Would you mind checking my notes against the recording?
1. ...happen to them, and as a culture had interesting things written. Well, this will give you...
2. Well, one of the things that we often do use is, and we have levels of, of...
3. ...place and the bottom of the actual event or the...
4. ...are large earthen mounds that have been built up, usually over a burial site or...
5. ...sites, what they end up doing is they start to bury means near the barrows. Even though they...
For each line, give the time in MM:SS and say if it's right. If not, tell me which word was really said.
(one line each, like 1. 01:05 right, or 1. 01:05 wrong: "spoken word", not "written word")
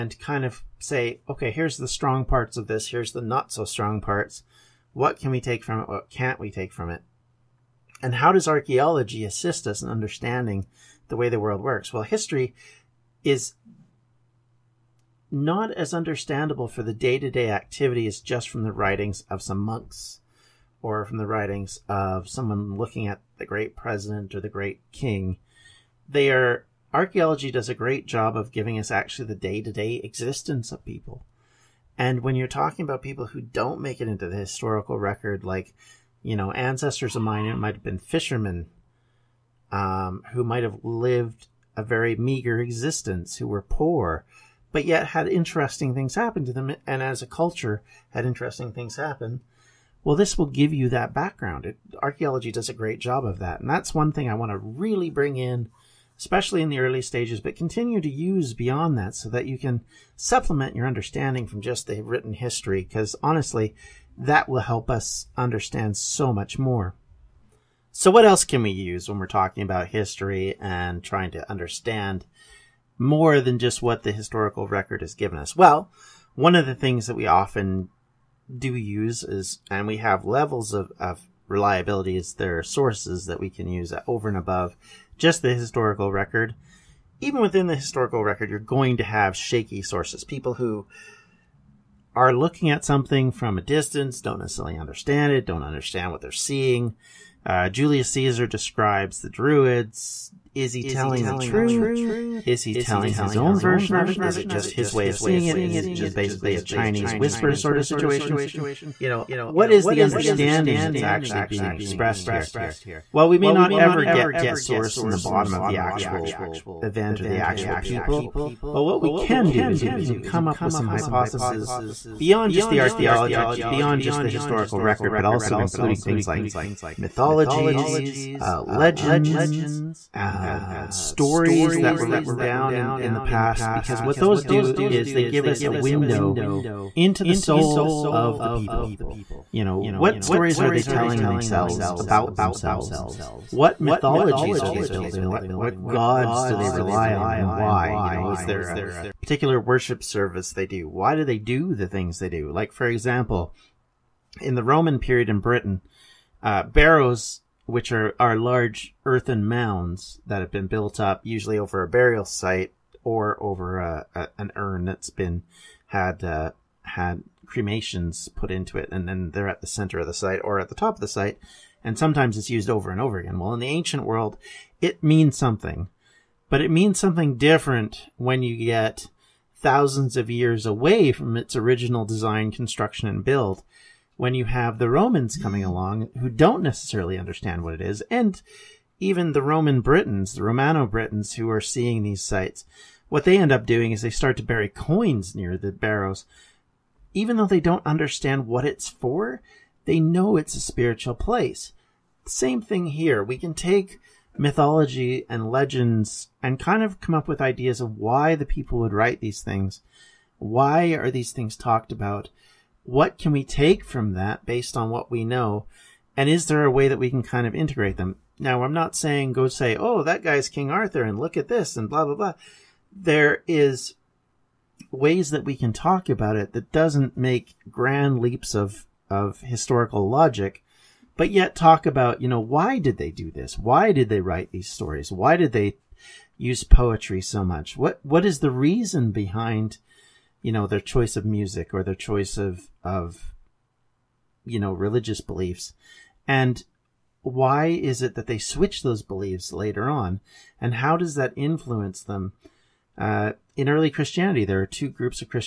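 1. 00:46 wrong: "happen", not "written"
2. 01:15 right
3. 01:54 wrong: "source", not "place"
4. 02:38 right
5. 03:12 wrong: "coins", not "means".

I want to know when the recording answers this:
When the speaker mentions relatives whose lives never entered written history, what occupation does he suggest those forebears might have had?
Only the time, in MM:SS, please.
00:37.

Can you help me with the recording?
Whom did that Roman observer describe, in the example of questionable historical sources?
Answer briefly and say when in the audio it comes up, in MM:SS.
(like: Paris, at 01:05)
The Druids, at 01:39.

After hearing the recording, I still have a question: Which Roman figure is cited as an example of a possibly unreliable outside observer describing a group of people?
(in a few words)
Julius Caesar.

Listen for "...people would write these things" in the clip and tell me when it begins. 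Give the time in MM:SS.
03:28.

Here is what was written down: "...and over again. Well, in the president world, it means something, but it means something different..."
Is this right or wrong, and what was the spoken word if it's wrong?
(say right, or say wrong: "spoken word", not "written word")
wrong: "ancient", not "president".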